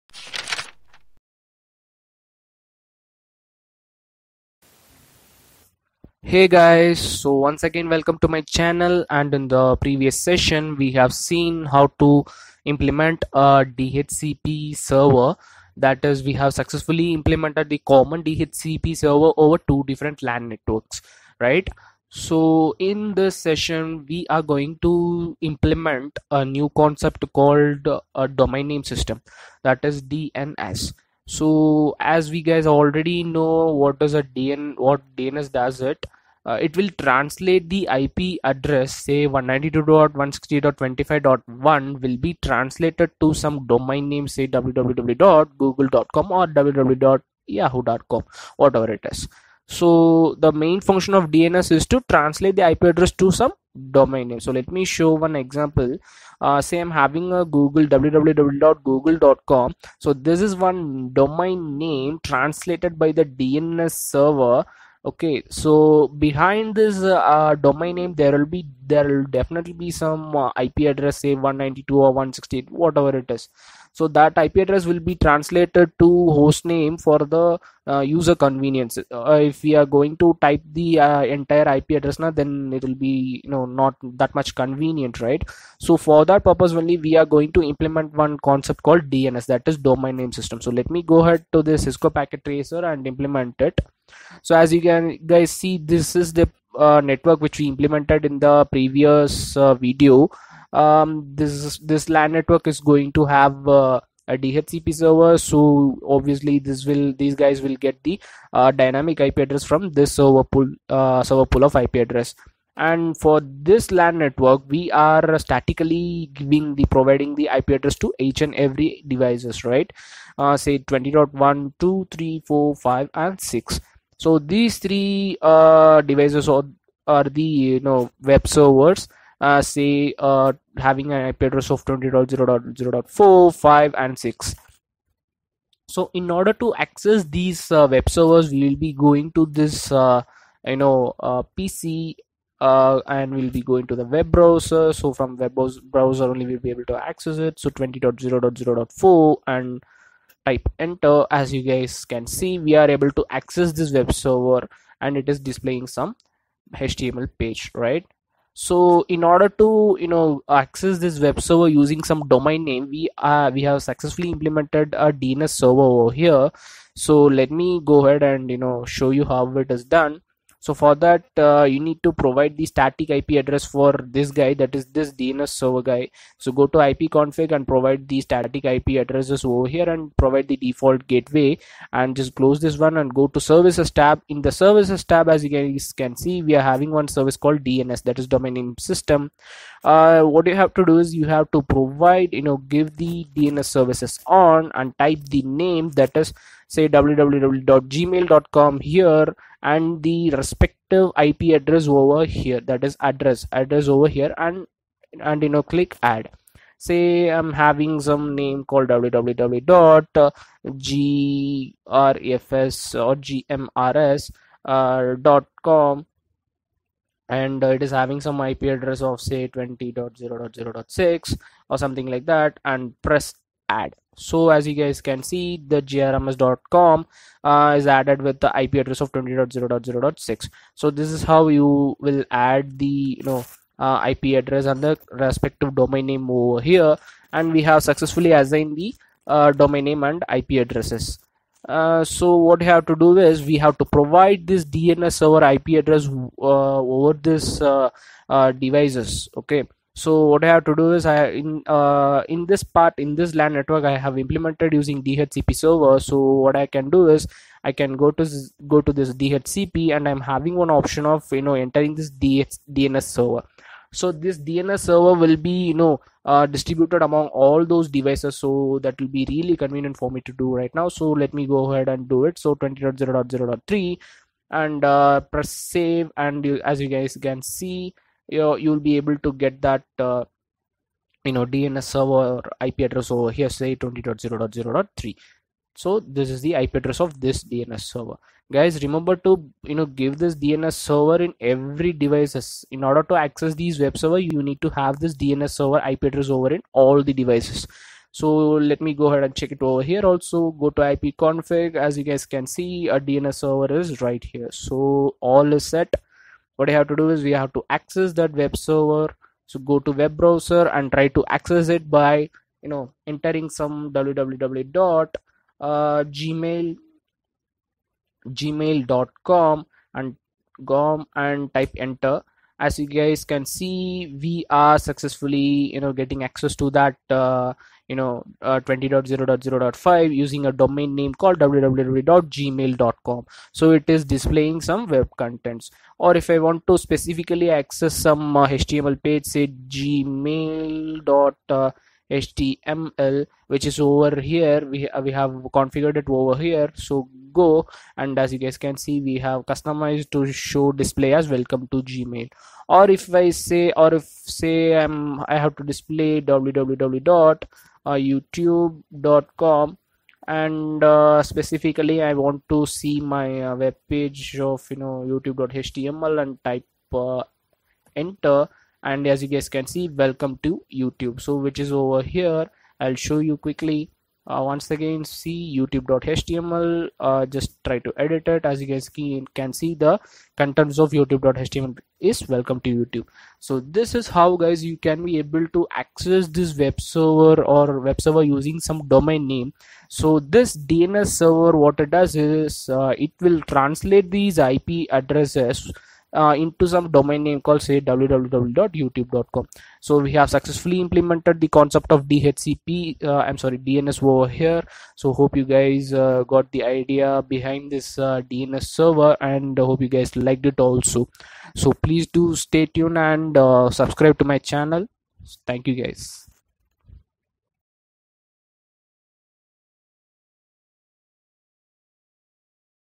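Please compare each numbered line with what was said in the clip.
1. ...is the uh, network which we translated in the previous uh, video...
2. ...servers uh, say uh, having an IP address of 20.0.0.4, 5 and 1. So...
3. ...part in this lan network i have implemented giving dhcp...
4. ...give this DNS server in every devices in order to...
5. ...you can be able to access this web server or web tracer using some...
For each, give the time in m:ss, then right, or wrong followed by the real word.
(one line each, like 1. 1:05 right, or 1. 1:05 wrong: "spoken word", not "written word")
1. 1:36 wrong: "implemented", not "translated"
2. 2:08 wrong: "6", not "1"
3. 4:12 wrong: "using", not "giving"
4. 4:49 right
5. 6:24 wrong: "server", not "tracer".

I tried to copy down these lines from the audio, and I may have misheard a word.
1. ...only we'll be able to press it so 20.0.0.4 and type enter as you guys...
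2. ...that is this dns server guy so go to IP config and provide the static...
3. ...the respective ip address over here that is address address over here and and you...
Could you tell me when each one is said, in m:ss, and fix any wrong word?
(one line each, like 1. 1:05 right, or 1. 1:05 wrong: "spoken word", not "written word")
1. 2:26 wrong: "access", not "press"
2. 2:54 right
3. 3:20 right.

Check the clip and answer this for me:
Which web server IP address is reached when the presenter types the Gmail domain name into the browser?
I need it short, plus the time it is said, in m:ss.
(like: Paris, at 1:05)
20.0.0.5, at 5:28.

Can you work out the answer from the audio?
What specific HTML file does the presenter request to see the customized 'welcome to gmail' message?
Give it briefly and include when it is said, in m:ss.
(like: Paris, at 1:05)
gmail.html, at 5:39.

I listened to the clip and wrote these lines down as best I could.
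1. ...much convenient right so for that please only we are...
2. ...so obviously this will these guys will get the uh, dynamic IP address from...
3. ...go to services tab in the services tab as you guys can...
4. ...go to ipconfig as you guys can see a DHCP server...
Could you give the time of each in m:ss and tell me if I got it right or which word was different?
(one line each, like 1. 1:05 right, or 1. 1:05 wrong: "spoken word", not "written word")
1. 1:24 wrong: "purpose", not "please"
2. 1:45 right
3. 3:03 right
4. 5:00 wrong: "DNS", not "DHCP".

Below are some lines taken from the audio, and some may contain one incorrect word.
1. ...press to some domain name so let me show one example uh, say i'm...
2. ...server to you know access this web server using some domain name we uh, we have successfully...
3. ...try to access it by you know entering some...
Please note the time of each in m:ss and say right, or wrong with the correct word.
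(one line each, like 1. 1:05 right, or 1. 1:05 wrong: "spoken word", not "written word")
1. 0:52 wrong: "address", not "press"
2. 2:39 wrong: "order", not "server"
3. 5:10 right.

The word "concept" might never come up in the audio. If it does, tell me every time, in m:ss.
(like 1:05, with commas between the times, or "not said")
0:26, 1:28, 6:41.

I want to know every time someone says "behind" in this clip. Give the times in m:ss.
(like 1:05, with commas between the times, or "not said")
1:06, 6:47.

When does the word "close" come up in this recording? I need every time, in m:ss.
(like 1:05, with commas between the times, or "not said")
3:02.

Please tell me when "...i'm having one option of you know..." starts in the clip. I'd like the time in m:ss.
4:20.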